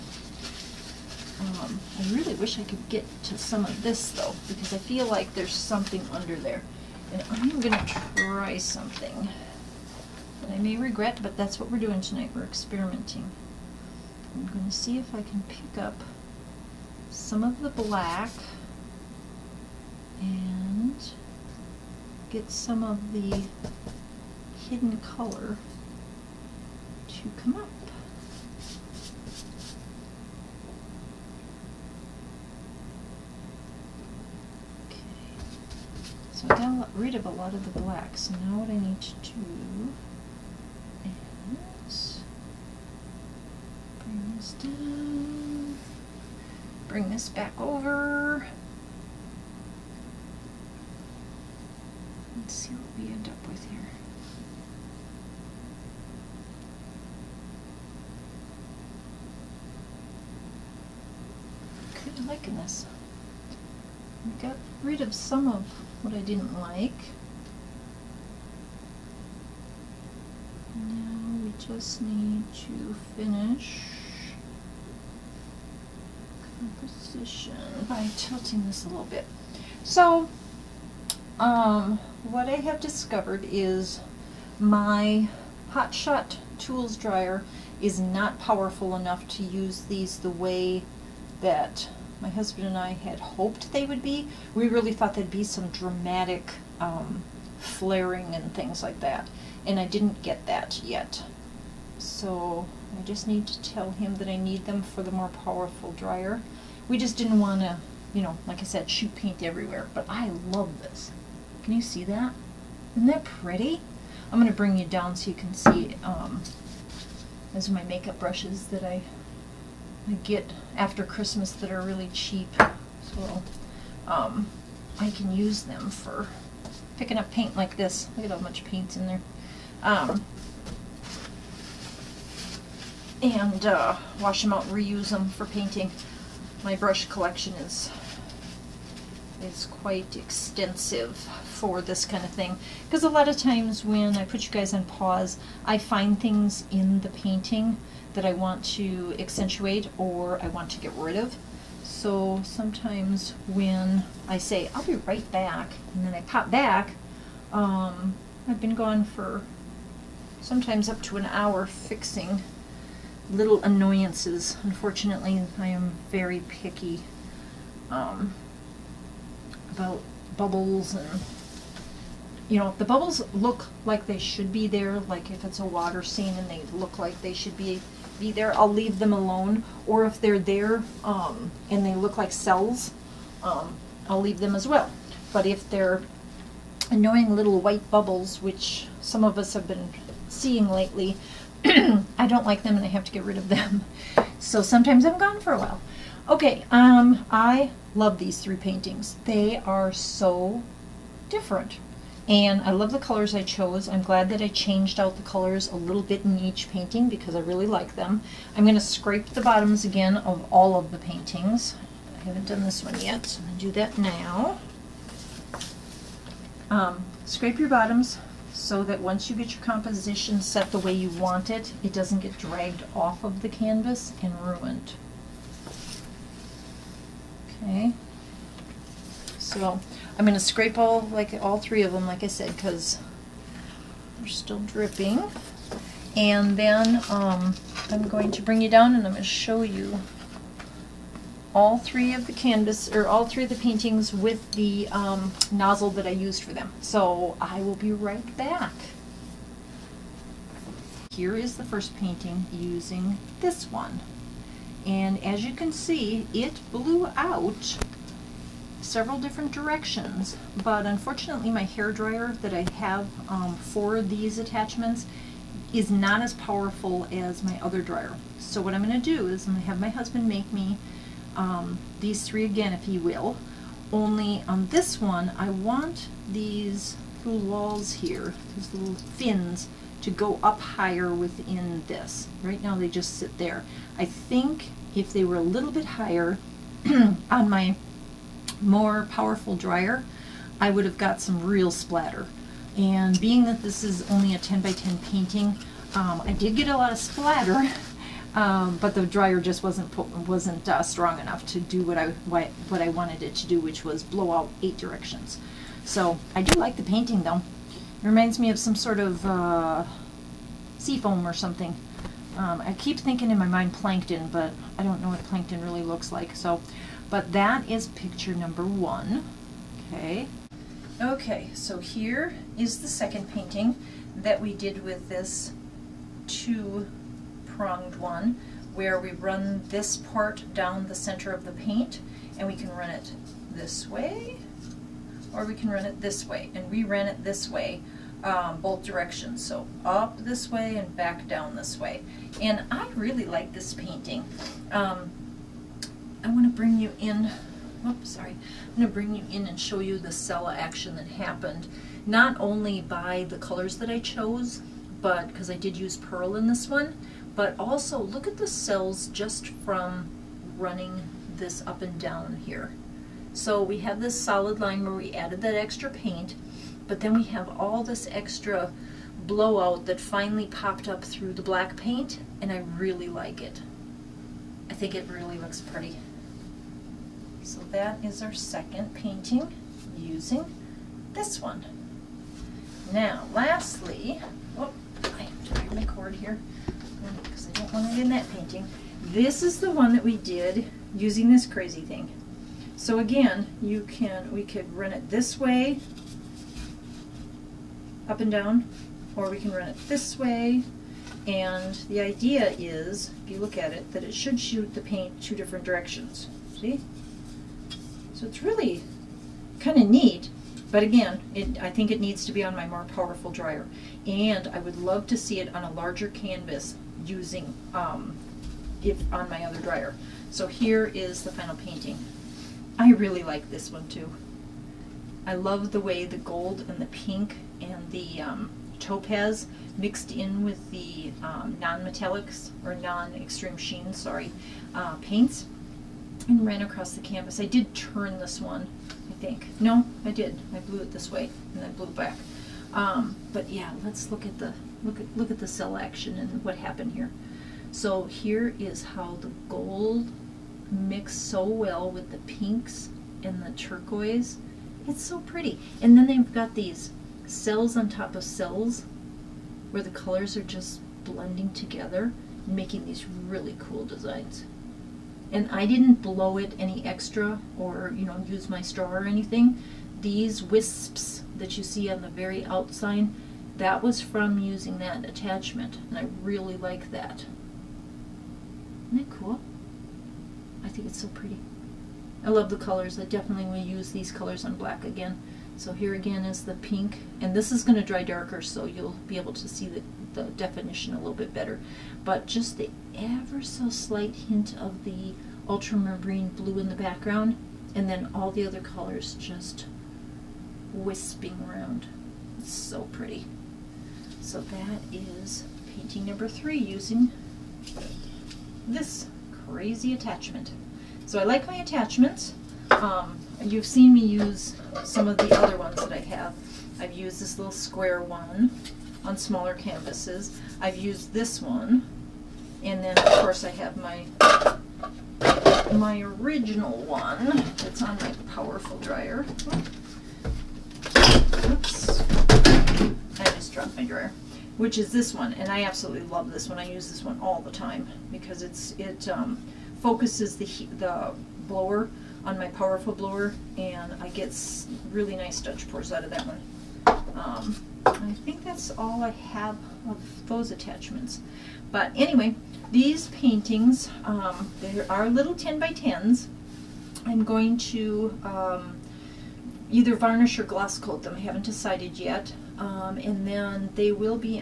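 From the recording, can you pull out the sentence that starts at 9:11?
But anyway, these paintings, um, they are little 10 by 10s.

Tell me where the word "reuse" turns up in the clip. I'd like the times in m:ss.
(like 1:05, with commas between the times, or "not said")
2:14.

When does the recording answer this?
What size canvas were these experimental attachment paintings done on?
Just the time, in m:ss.
4:54.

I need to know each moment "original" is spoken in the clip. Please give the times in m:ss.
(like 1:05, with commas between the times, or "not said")
8:46.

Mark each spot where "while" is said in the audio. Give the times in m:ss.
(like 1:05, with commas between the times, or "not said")
3:15.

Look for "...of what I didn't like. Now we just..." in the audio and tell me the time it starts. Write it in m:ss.
1:05.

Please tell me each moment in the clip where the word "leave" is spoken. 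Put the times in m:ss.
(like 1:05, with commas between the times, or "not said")
2:58, 3:04.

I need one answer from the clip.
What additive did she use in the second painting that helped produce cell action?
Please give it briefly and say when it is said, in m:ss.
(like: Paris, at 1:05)
pearl, at 5:55.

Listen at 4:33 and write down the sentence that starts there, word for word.
Only on this one, I want these little walls here, these little fins, to go up higher within this.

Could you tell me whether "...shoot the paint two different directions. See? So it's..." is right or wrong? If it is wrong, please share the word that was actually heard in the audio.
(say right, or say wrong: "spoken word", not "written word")
right.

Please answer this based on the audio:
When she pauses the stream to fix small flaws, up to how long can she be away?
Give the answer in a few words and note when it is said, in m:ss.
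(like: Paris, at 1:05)
an hour, at 2:40.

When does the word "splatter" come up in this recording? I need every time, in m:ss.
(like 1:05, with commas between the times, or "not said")
4:51, 4:56.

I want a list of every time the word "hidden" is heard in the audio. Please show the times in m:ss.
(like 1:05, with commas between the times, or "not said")
0:24.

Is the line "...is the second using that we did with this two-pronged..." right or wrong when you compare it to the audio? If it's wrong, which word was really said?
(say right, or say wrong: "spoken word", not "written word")
wrong: "painting", not "using".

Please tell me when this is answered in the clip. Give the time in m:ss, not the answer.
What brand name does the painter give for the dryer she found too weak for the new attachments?
1:25.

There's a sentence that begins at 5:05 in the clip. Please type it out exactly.
So I do like the painting though.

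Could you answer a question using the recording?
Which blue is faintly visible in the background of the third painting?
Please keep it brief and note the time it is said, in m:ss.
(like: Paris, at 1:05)
ultramarine blue, at 8:15.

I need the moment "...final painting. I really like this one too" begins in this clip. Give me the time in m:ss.
7:01.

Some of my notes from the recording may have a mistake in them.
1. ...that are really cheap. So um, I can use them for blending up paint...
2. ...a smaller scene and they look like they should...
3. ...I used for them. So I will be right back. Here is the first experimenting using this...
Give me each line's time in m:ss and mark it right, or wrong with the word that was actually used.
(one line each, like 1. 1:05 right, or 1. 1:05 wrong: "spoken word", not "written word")
1. 2:01 wrong: "picking", not "blending"
2. 2:55 wrong: "water", not "smaller"
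3. 4:06 wrong: "painting", not "experimenting".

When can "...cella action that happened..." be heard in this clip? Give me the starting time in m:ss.
5:50.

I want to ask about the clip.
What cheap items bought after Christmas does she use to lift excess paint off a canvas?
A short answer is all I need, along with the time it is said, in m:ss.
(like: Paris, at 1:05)
makeup brushes, at 1:57.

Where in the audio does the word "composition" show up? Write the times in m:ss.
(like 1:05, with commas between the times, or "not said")
1:16, 3:39.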